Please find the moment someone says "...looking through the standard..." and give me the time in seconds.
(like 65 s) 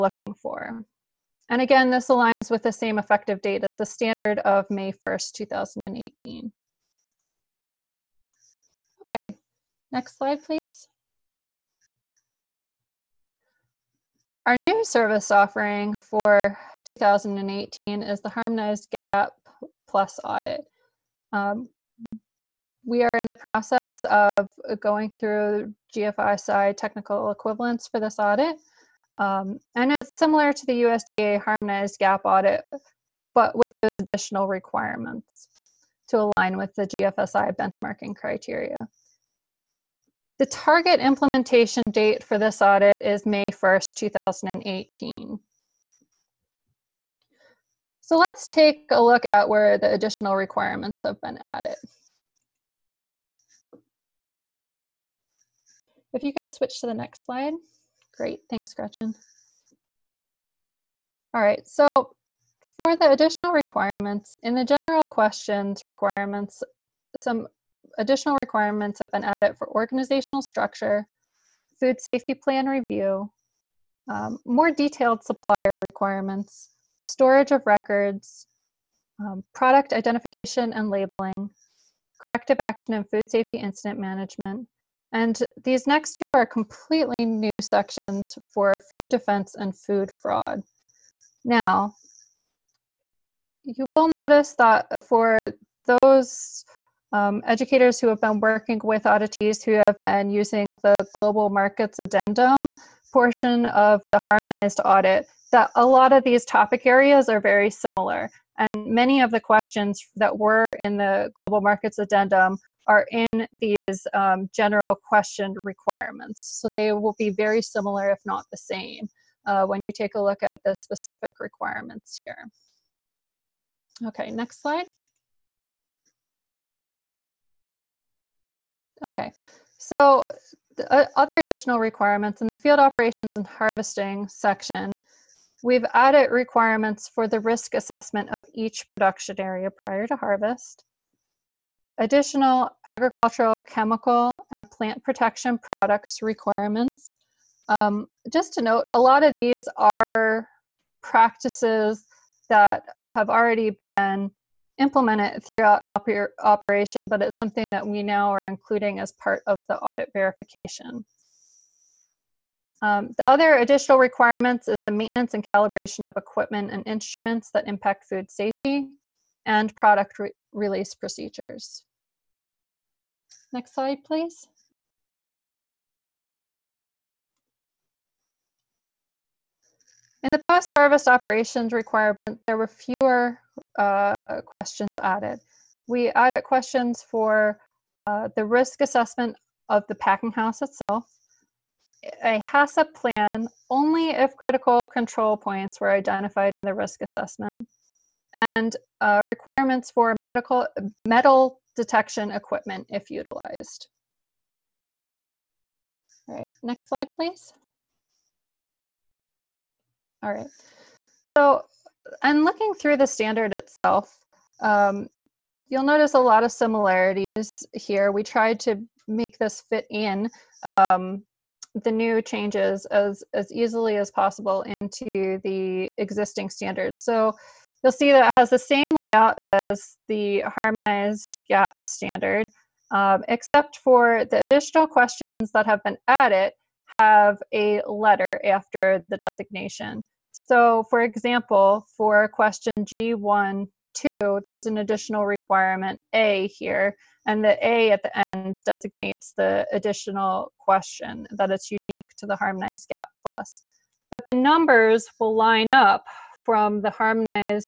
212 s.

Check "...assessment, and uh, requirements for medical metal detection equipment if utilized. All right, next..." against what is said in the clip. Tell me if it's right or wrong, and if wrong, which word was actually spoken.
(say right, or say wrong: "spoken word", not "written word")
right.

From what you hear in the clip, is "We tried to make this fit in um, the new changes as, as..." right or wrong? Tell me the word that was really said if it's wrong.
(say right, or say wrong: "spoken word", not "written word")
right.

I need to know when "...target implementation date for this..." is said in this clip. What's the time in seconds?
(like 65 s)
40 s.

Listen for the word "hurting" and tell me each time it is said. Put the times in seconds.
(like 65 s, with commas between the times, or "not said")
not said.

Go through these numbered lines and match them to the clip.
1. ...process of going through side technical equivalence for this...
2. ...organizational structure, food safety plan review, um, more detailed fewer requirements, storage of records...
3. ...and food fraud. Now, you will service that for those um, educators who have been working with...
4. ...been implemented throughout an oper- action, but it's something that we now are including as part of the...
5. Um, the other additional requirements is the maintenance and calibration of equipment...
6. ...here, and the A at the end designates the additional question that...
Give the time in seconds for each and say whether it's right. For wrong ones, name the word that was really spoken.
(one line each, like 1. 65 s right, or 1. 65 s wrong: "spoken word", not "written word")
1. 23 s right
2. 69 s wrong: "supplier", not "fewer"
3. 89 s wrong: "notice", not "service"
4. 153 s wrong: "operation", not "action"
5. 162 s right
6. 246 s right.